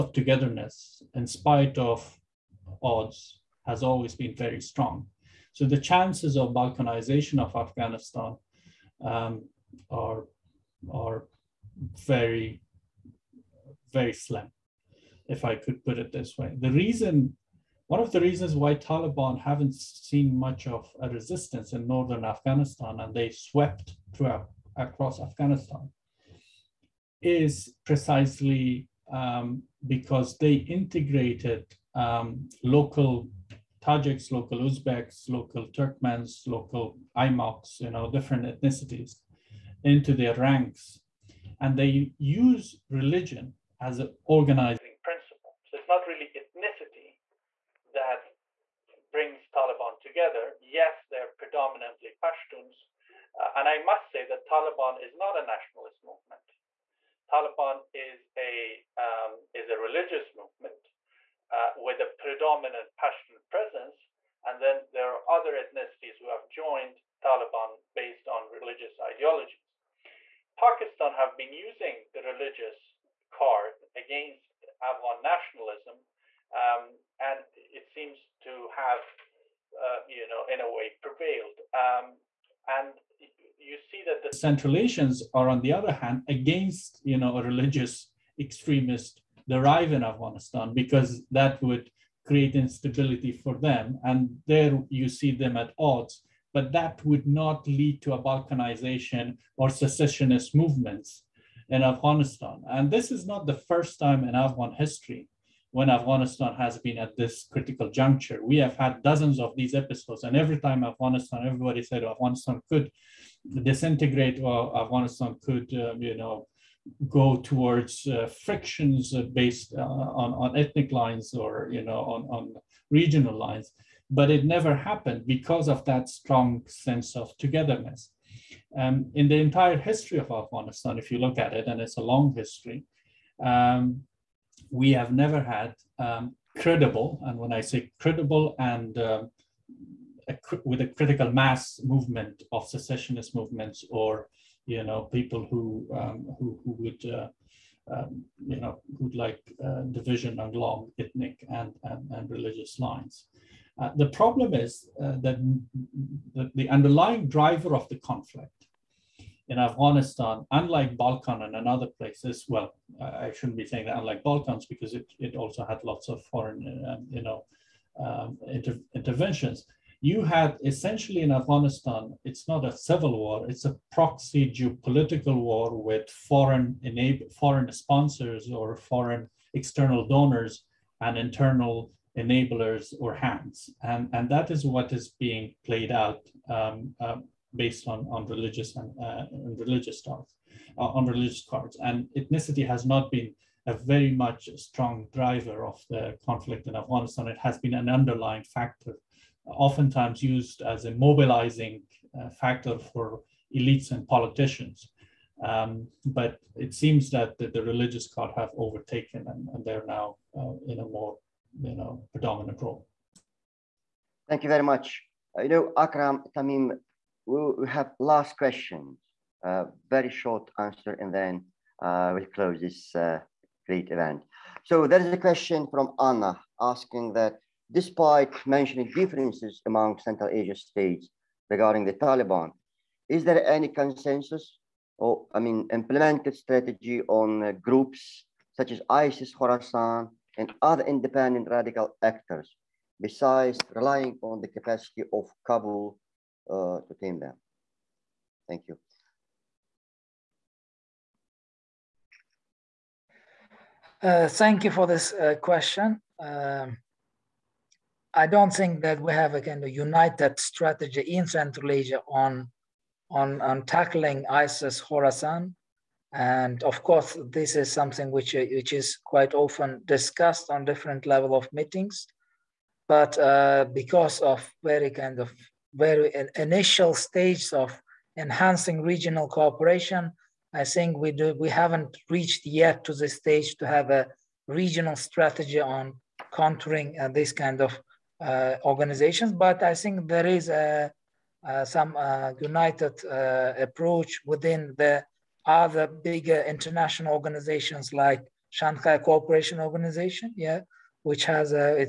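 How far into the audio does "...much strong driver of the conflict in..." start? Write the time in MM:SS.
03:14.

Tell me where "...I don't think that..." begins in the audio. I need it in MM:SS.
04:18.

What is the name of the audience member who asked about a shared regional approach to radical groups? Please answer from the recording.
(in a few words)
Anna.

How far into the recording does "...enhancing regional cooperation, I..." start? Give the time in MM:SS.
04:38.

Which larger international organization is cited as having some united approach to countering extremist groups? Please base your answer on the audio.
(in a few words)
Shanghai Cooperation Organization.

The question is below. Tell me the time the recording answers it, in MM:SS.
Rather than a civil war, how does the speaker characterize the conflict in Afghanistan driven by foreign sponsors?
02:53.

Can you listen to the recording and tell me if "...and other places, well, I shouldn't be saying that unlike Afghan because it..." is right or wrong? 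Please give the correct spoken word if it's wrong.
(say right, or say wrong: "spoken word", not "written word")
wrong: "Balkans", not "Afghan".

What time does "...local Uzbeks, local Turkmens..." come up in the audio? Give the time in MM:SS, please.
00:34.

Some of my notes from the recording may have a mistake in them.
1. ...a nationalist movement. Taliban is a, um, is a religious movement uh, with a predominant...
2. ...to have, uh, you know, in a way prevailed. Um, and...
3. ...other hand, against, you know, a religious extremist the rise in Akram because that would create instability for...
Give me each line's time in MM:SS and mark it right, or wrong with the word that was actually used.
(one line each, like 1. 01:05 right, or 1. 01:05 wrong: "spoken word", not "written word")
1. 00:55 right
2. 01:18 right
3. 01:25 wrong: "Afghanistan", not "Akram".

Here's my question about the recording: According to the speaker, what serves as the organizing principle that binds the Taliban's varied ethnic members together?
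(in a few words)
Religion.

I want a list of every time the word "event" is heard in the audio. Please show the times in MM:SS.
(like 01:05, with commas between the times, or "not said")
03:43.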